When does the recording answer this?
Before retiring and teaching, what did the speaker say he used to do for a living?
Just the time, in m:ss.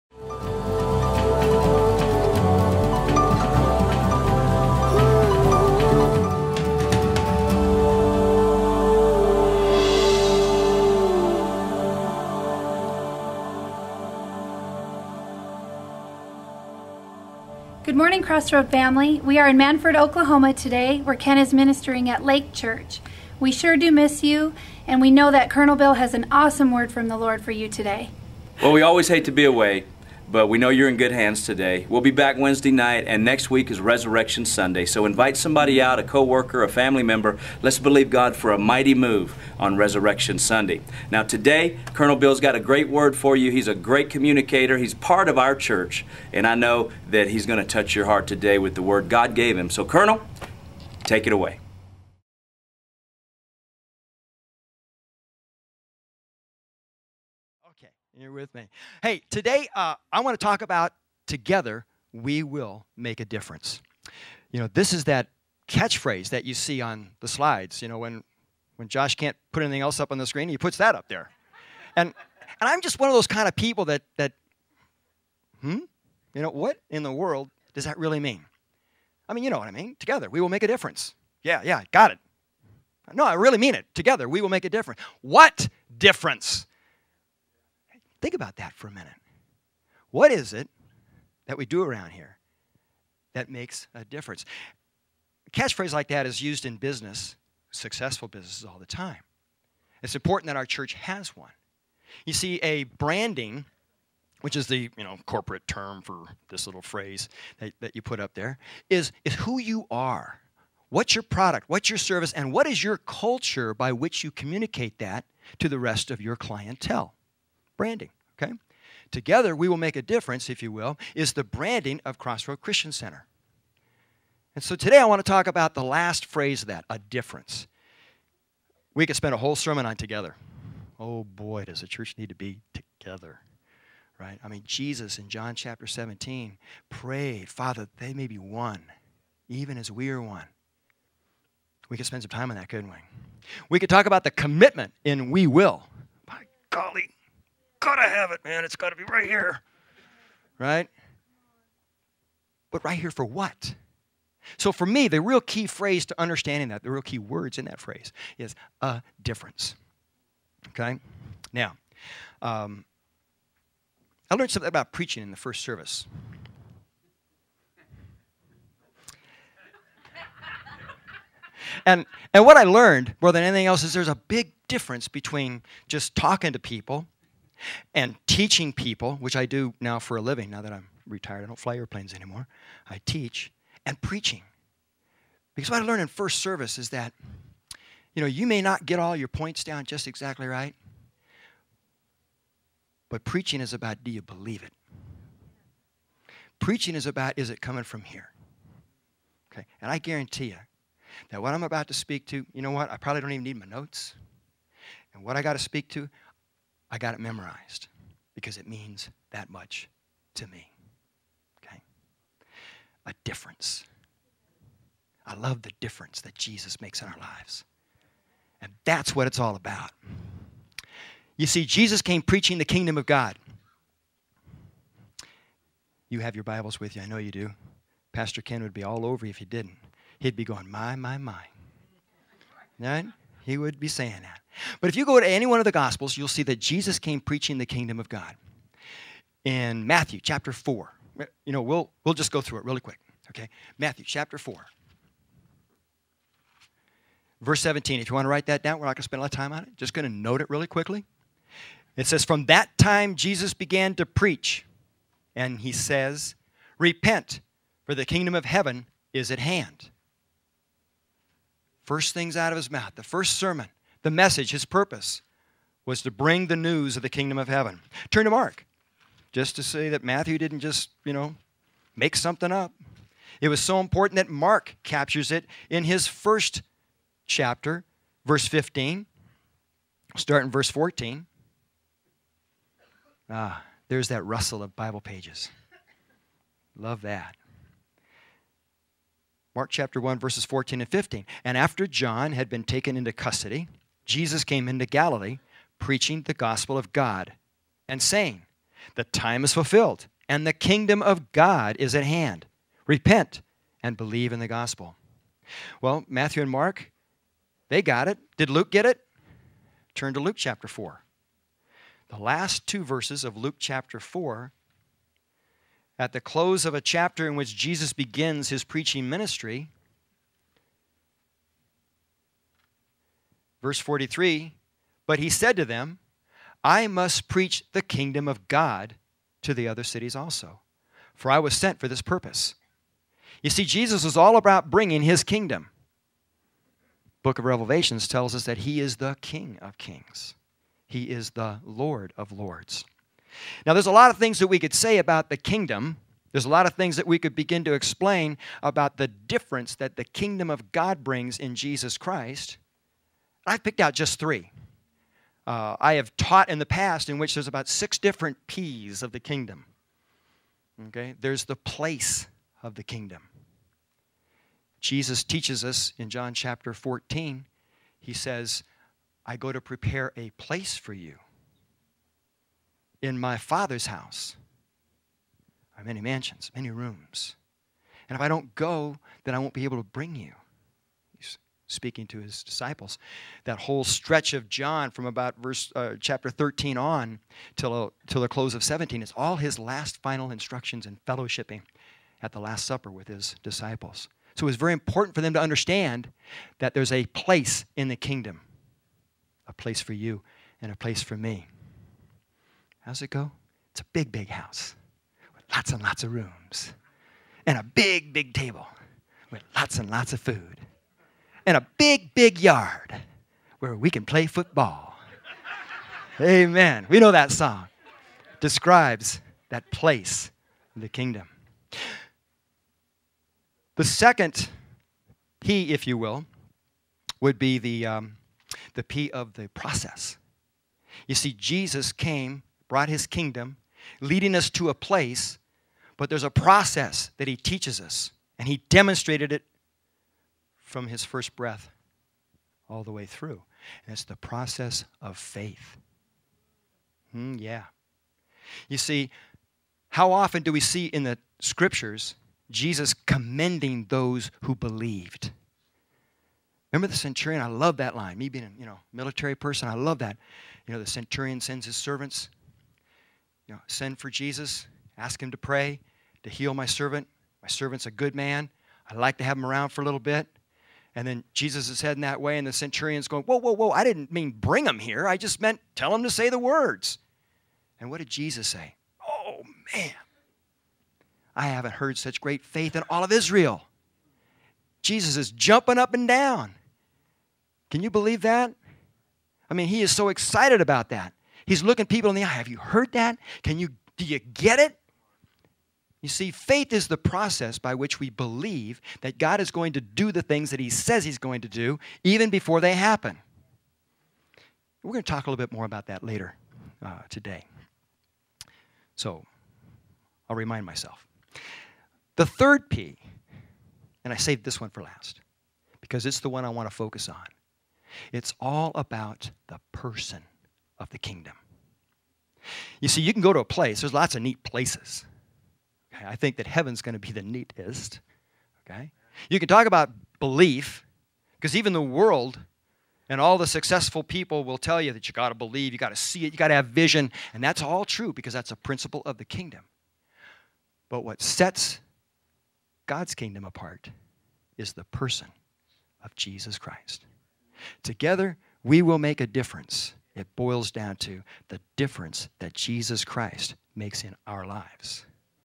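3:01.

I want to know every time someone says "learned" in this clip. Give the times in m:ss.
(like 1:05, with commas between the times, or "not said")
2:44, 2:52, 3:05.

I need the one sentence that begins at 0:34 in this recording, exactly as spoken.
So invite somebody out, a coworker, a family member.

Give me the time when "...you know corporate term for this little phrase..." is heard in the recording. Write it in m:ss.
1:44.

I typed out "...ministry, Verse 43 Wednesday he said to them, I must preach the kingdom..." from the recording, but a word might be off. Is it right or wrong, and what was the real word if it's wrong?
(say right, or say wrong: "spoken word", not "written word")
wrong: "But", not "Wednesday".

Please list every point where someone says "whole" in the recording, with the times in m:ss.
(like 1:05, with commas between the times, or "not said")
2:09, 6:23.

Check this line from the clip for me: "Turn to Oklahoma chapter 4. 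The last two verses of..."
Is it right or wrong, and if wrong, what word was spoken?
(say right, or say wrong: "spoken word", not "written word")
wrong: "Luke", not "Oklahoma".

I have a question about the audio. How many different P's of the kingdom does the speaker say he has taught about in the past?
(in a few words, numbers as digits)
6.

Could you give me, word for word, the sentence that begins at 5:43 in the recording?
Now, there's a lot of things that we could say about the kingdom.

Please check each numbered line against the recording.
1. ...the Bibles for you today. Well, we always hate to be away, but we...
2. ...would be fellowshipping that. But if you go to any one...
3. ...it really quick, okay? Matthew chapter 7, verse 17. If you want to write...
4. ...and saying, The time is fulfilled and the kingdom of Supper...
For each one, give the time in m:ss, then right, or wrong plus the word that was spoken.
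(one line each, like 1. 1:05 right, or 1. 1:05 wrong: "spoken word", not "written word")
1. 0:27 wrong: "Lord", not "Bibles"
2. 3:53 wrong: "saying", not "fellowshipping"
3. 4:02 wrong: "4", not "7"
4. 4:57 wrong: "God", not "Supper".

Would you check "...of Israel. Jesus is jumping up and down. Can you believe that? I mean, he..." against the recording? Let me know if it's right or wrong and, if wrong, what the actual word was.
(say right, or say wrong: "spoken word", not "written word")
right.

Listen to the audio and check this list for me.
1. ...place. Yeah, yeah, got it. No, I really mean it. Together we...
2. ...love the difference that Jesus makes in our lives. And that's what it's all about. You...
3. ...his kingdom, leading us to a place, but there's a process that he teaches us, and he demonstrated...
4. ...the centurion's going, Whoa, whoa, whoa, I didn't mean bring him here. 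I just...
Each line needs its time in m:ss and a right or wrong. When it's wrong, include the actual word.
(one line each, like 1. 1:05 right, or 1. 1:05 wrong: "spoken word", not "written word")
1. 1:20 wrong: "difference", not "place"
2. 3:35 right
3. 7:12 right
4. 7:52 right.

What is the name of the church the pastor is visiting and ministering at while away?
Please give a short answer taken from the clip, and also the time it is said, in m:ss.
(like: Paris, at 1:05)
Lake Church, at 0:22.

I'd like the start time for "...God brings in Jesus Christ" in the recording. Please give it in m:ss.
5:50.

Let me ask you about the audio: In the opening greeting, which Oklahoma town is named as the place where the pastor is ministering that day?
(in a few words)
Mannford.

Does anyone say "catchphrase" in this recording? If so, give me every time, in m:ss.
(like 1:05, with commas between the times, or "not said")
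1:05, 1:35.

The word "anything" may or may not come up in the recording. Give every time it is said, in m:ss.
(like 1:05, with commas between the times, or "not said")
1:09, 2:53.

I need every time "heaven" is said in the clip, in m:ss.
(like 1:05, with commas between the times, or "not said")
4:18, 4:27, 8:46.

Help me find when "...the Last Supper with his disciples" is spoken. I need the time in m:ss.
6:32.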